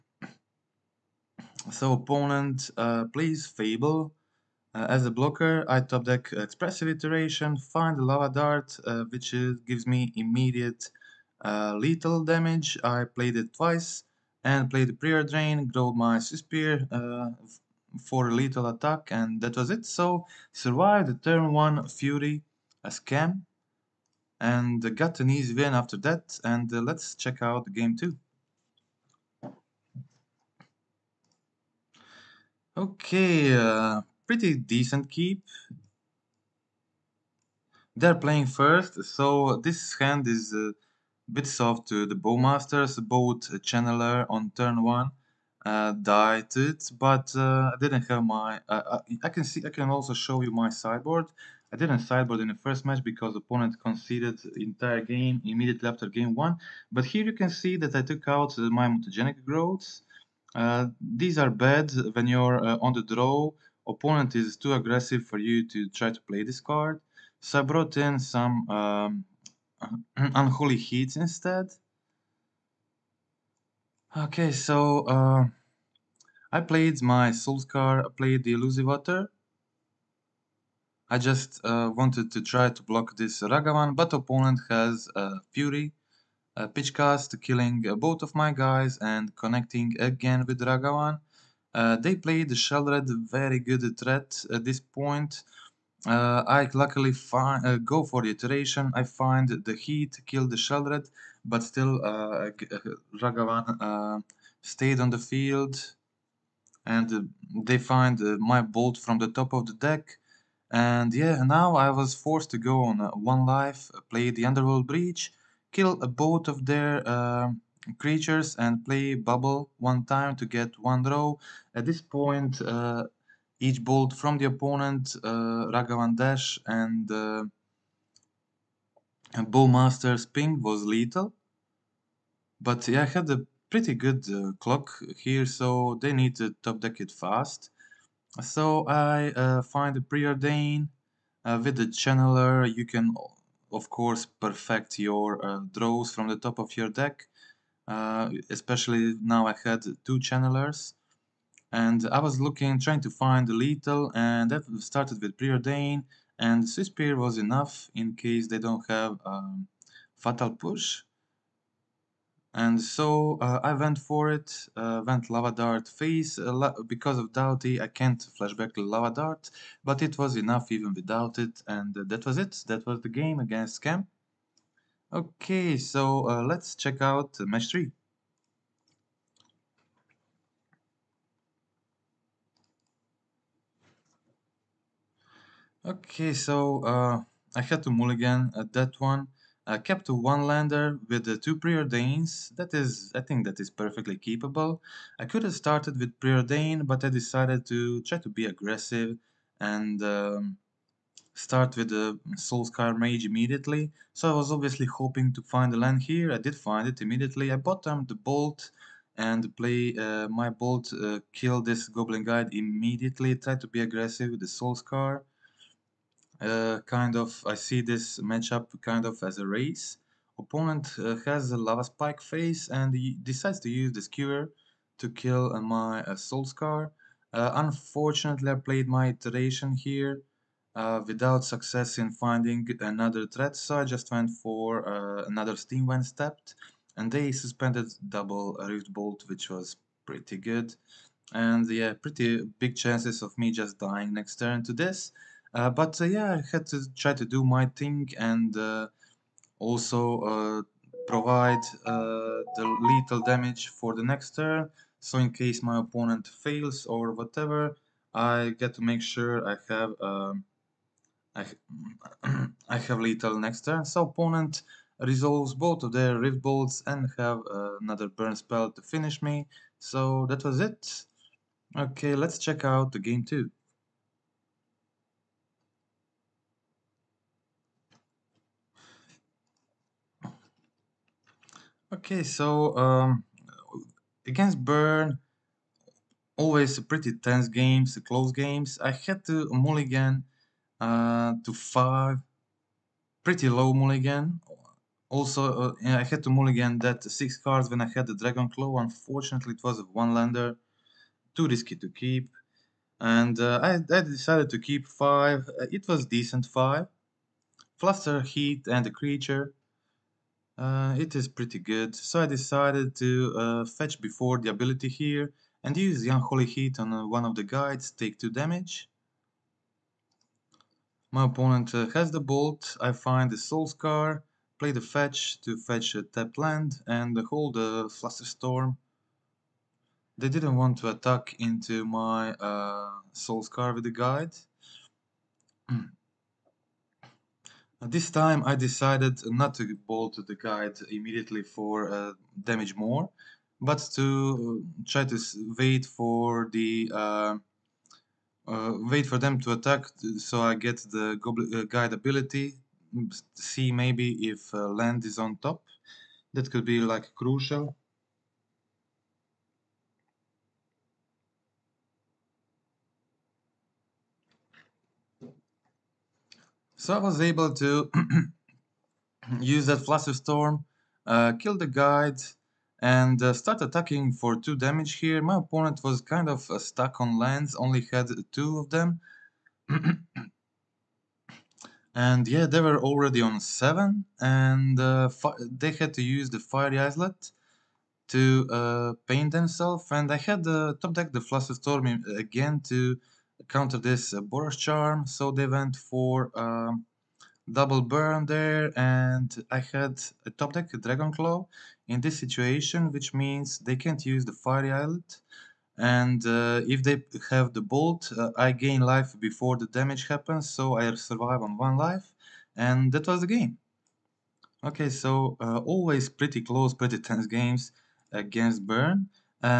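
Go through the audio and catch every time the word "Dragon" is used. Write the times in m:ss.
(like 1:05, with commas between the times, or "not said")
4:58, 6:40.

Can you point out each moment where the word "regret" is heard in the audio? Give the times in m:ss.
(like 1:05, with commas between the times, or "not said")
not said.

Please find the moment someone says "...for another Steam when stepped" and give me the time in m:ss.
3:54.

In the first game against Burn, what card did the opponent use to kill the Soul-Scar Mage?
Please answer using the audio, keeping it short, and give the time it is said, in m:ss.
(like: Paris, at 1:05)
Skewer, at 3:43.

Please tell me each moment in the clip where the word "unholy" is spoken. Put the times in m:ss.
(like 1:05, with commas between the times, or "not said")
1:10, 5:16.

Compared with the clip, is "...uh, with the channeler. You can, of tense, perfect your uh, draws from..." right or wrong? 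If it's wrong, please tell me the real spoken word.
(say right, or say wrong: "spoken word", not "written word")
wrong: "course", not "tense".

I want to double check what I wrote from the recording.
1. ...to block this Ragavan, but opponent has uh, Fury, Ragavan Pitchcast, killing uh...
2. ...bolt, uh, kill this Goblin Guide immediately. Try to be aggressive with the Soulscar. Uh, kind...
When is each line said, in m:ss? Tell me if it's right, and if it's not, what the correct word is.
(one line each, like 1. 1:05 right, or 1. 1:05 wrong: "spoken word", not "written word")
1. 1:22 wrong: "Pitch", not "Ragavan"
2. 3:30 right.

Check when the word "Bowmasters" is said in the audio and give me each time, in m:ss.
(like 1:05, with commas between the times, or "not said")
0:42, 2:09.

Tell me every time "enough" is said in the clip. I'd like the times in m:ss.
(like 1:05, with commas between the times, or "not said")
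2:37, 2:50.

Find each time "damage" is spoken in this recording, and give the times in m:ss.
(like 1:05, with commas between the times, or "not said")
0:12, 4:13, 5:18, 5:42, 6:14, 6:49.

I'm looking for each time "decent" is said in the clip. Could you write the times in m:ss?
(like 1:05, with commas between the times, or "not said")
0:34, 5:06.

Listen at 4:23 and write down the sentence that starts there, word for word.
So opponent resolves both of their rift bolts and have uh, another burn spell to finish me.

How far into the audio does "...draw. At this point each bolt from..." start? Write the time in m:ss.
2:01.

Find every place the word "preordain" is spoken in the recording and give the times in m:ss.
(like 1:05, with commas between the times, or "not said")
0:14, 2:19, 2:35, 3:11, 3:16.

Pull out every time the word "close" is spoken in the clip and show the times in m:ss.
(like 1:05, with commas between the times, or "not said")
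4:48, 6:56.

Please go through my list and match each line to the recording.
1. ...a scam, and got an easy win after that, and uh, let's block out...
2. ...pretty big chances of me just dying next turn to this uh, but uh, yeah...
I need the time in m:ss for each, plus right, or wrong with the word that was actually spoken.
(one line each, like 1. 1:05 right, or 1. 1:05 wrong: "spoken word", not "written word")
1. 0:22 wrong: "check", not "block"
2. 4:02 right.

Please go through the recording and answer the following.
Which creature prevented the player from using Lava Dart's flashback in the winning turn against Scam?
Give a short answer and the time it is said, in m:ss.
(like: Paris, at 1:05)
Dauthi, at 2:47.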